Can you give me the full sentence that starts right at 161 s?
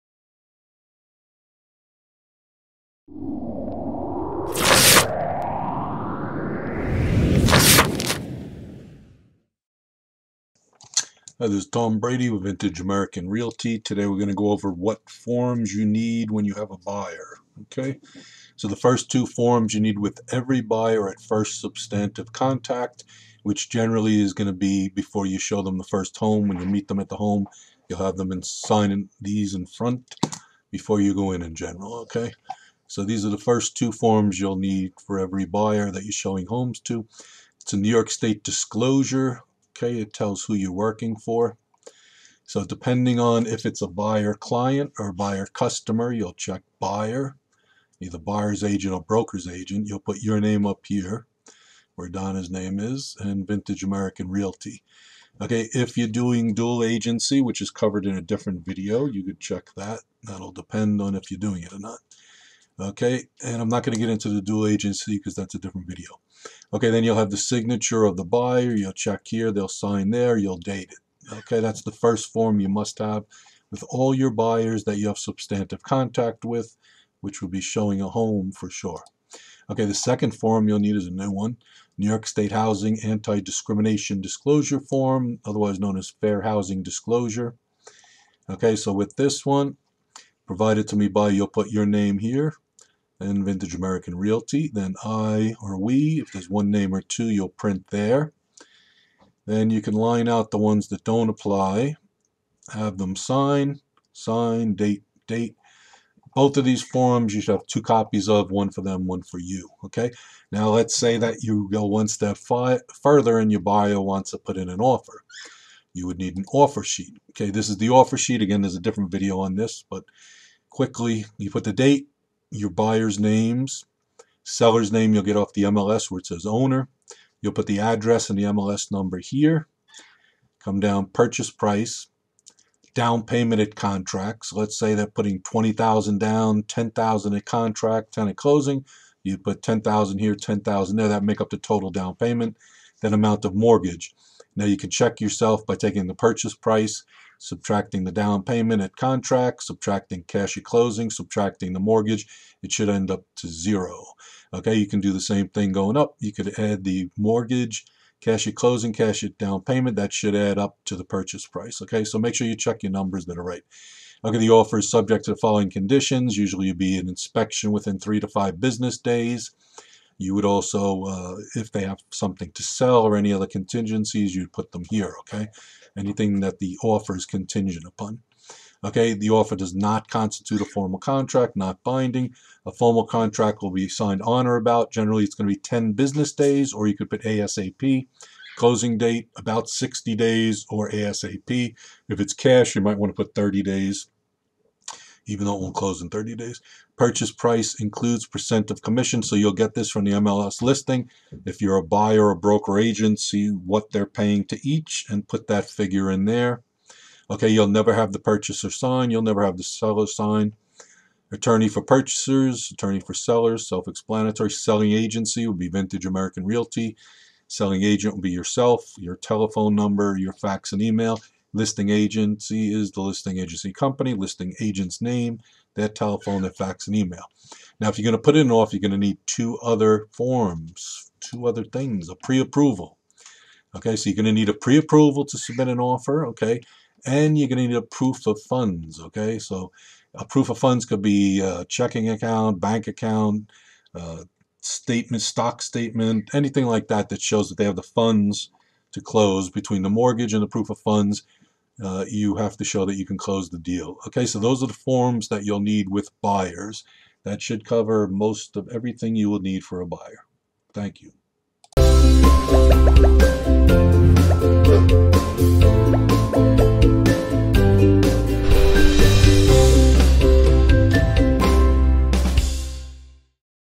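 Okay, so make sure you check your numbers that are right.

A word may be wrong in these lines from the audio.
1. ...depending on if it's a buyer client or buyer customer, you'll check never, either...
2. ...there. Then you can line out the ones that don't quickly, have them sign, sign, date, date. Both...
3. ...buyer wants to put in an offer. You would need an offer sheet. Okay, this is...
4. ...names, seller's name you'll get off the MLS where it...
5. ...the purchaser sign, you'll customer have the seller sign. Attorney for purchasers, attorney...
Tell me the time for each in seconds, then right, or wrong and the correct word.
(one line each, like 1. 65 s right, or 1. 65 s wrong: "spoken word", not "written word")
1. 42 s wrong: "buyer", not "never"
2. 97 s wrong: "apply", not "quickly"
3. 113 s right
4. 123 s right
5. 208 s wrong: "never", not "customer".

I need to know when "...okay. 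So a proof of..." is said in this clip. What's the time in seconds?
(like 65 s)
239 s.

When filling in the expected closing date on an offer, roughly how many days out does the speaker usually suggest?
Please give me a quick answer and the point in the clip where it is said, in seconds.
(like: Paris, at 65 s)
60 days, at 189 s.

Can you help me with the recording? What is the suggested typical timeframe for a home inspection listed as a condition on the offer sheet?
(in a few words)
3 to 5 business days.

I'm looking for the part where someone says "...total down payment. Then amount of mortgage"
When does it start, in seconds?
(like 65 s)
141 s.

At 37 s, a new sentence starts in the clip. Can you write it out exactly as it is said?
It's a New York State disclosure.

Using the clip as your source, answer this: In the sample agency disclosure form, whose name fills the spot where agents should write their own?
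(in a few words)
Donna.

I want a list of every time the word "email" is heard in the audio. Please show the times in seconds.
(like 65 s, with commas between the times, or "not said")
220 s, 226 s.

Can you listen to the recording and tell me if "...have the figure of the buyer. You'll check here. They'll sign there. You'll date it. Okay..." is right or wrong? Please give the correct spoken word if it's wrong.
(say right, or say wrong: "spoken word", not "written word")
wrong: "signature", not "figure".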